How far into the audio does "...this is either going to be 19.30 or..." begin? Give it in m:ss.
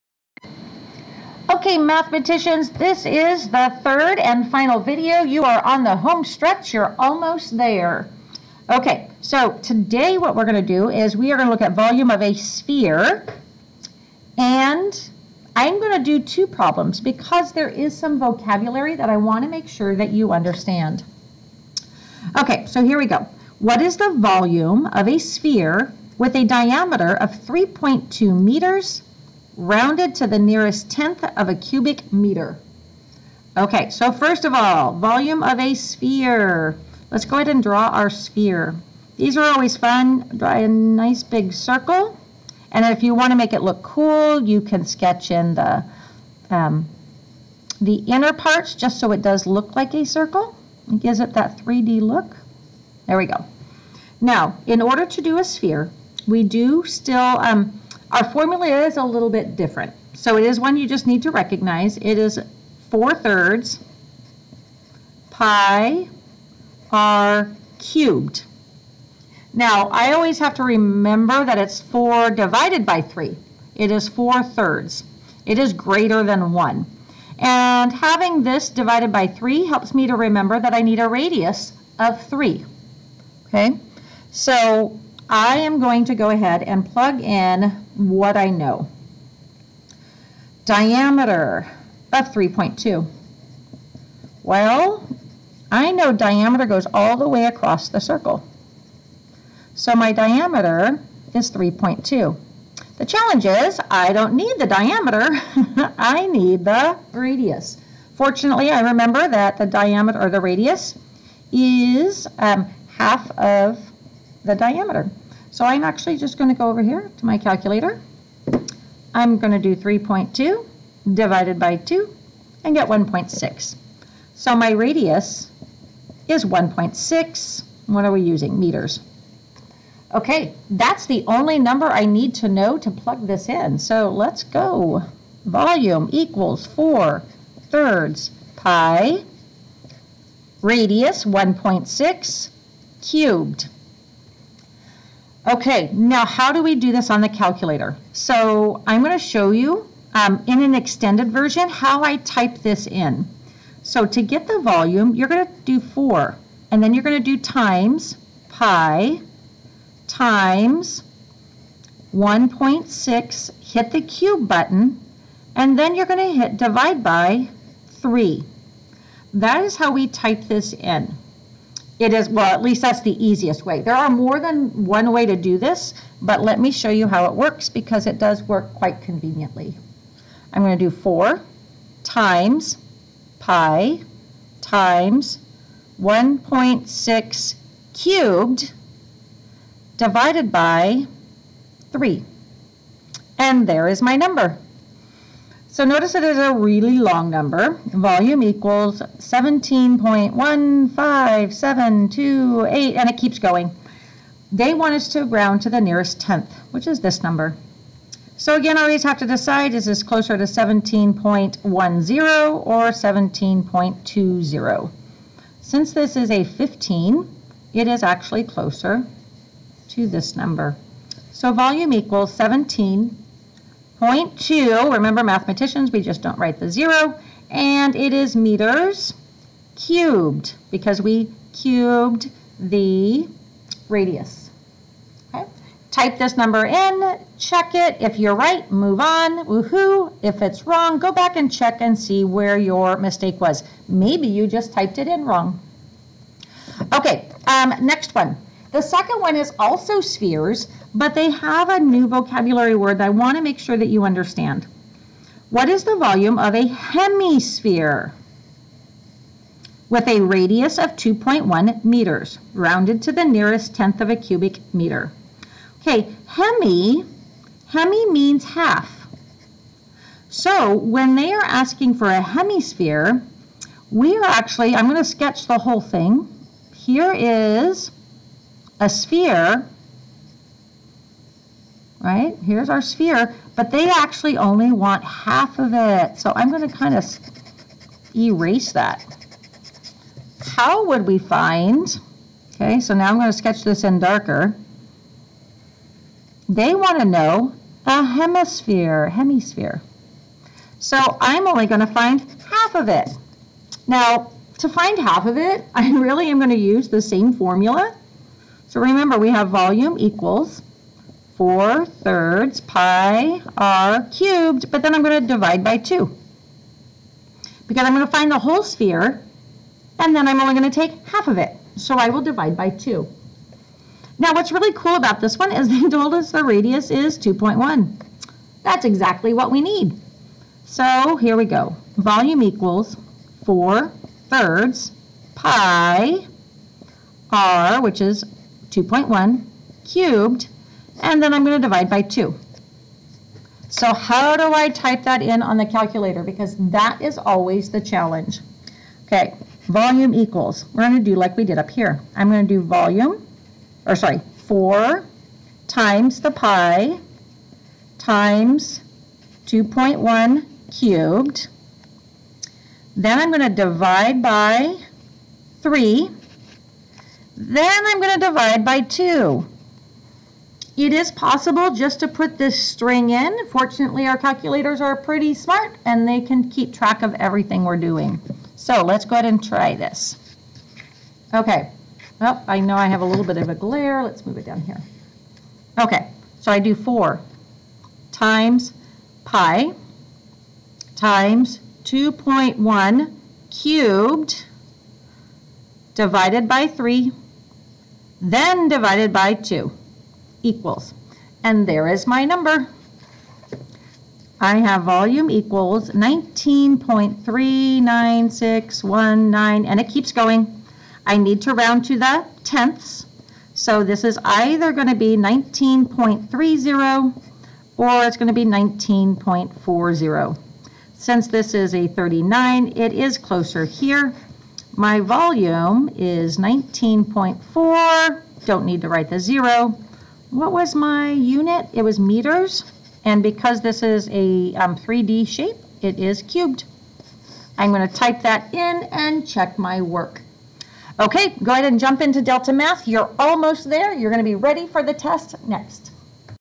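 6:53.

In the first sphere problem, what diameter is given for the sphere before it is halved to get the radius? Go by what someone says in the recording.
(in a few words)
3.2 meters.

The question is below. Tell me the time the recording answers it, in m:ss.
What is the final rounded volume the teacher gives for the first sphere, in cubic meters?
3:42.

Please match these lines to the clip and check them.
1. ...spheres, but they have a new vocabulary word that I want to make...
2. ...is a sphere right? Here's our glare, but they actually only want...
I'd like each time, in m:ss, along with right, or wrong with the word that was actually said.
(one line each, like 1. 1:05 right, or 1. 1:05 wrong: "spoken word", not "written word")
1. 4:09 right
2. 4:37 wrong: "sphere", not "glare".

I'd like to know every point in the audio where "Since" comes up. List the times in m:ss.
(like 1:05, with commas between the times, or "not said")
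3:35, 7:00.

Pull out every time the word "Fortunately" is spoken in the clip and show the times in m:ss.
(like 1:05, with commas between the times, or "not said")
1:48, 6:13.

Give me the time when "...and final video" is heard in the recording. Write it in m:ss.
0:04.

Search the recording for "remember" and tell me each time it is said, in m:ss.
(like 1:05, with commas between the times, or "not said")
1:10, 1:20, 1:48, 3:44, 5:08.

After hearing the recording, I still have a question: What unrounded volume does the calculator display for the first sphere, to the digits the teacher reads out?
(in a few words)
17.15728.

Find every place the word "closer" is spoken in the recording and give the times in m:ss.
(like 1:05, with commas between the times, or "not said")
3:30, 3:38, 7:03.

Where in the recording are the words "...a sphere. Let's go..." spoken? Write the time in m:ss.
0:35.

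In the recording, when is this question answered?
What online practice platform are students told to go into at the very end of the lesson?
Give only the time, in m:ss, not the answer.
7:22.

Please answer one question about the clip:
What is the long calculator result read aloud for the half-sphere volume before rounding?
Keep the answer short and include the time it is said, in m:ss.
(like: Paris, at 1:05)
19.39619, at 6:45.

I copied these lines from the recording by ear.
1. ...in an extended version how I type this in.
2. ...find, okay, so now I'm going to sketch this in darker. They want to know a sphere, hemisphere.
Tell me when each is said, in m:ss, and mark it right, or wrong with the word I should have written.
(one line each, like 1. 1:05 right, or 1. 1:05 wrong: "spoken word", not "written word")
1. 2:30 right
2. 4:51 wrong: "hemisphere", not "sphere".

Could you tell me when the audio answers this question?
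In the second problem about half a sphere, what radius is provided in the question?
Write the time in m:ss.
4:20.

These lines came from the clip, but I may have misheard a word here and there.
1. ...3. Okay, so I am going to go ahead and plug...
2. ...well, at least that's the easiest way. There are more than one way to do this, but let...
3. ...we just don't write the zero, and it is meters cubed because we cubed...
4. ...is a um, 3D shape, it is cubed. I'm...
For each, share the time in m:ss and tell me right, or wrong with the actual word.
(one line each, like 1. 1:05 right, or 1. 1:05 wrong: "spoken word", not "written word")
1. 1:22 right
2. 2:52 right
3. 3:45 right
4. 7:13 right.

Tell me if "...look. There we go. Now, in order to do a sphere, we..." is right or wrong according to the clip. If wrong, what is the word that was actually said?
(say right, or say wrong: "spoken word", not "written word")
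right.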